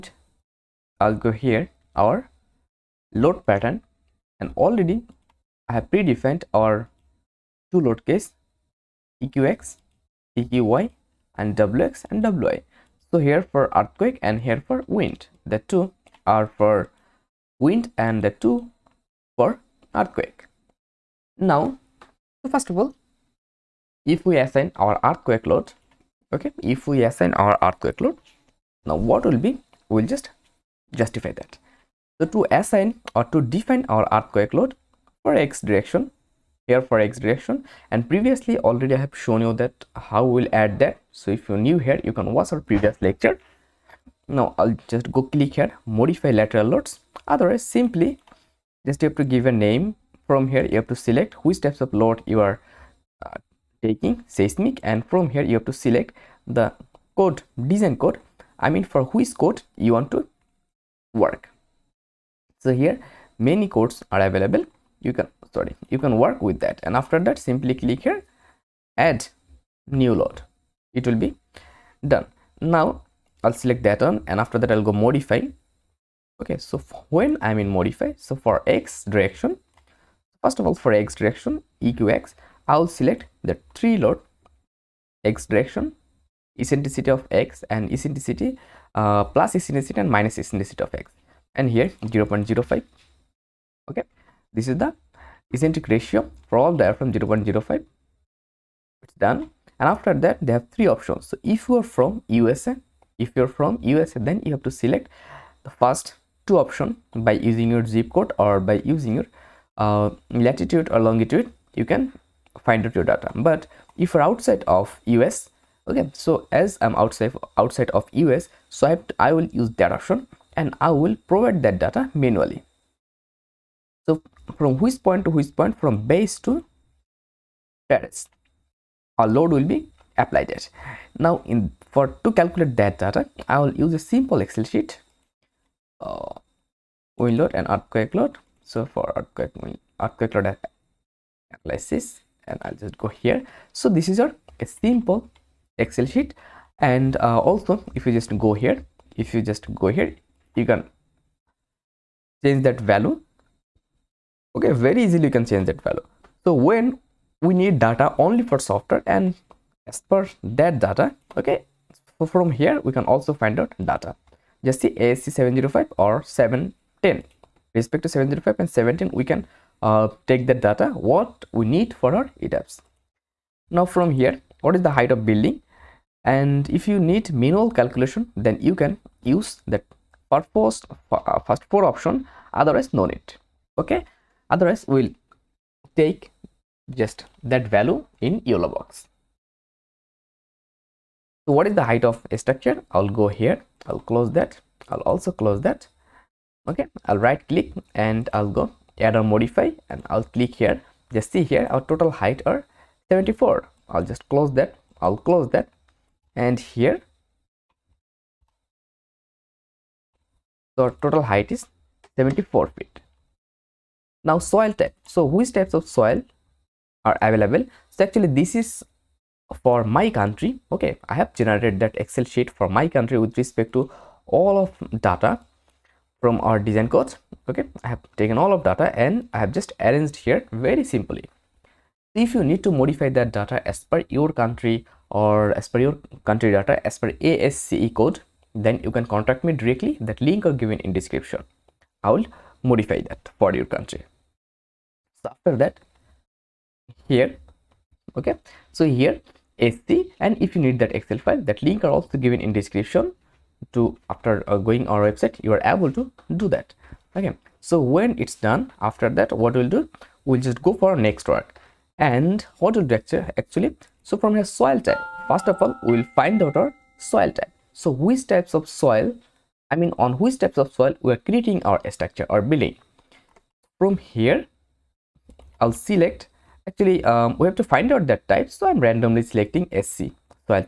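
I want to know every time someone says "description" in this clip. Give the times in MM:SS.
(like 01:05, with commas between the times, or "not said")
04:01, 04:12.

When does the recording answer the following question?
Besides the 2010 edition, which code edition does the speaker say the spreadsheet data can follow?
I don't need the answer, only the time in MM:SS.
02:45.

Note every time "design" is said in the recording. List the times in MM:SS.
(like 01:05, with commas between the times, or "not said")
00:57, 03:46.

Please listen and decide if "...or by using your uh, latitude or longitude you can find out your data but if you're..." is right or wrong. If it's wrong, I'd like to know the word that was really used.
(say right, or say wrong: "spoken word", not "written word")
right.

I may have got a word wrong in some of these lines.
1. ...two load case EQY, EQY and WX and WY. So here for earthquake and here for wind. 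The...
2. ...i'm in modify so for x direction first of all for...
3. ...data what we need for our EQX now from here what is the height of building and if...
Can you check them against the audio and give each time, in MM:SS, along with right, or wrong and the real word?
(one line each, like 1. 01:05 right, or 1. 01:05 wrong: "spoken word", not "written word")
1. 00:07 wrong: "EQX", not "EQY"
2. 01:17 right
3. 02:50 wrong: "ETABS", not "EQX".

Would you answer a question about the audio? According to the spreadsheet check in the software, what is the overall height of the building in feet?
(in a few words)
74 feet.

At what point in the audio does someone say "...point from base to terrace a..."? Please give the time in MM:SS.
02:05.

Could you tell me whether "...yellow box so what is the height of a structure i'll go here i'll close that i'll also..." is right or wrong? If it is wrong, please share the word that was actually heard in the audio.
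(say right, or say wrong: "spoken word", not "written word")
right.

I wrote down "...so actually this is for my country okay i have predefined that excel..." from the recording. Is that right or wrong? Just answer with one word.
wrong.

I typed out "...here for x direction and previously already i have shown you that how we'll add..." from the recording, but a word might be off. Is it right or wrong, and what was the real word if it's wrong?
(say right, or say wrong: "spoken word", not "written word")
right.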